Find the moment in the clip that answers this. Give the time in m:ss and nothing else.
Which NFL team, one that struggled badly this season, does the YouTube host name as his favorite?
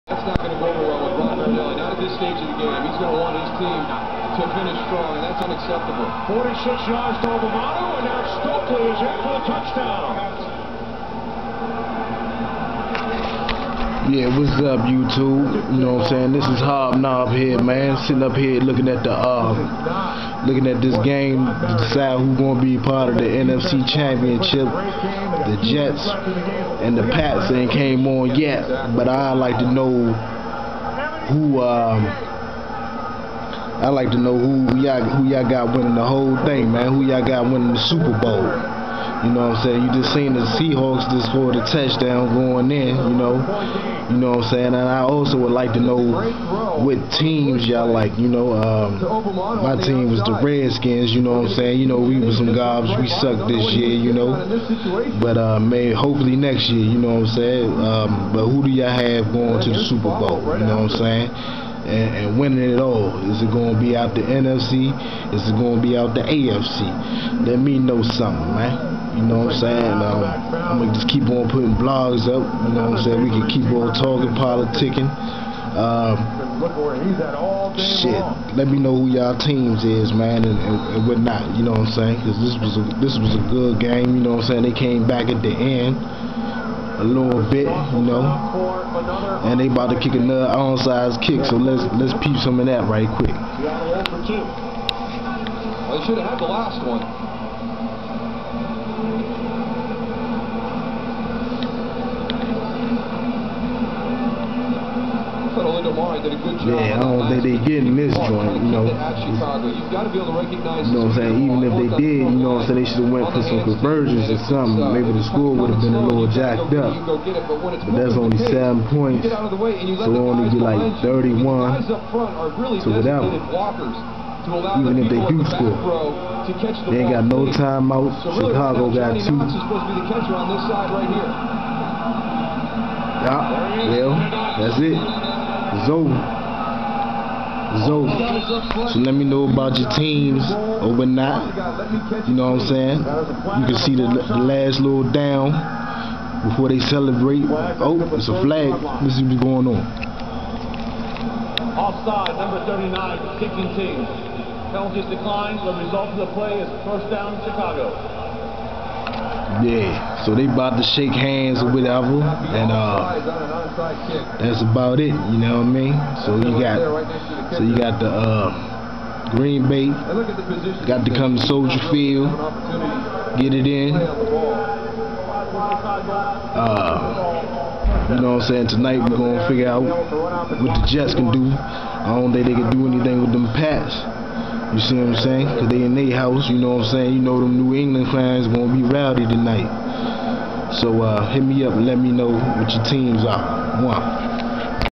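0:50.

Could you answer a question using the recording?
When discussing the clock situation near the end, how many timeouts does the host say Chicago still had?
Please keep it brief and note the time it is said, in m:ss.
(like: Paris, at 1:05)
2, at 2:09.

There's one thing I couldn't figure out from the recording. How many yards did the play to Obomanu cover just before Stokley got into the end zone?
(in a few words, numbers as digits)
46.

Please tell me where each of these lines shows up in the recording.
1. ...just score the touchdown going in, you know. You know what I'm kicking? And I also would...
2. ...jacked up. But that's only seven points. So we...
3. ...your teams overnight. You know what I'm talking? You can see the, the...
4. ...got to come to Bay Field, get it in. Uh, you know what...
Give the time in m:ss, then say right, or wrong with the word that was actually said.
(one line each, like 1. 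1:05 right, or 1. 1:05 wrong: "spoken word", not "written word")
1. 0:41 wrong: "saying", not "kicking"
2. 1:56 right
3. 2:19 wrong: "saying", not "talking"
4. 2:50 wrong: "Soldier", not "Bay".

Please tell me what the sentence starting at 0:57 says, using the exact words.
Um, but who do y'all have going to the Super Bowl, you know what I'm saying?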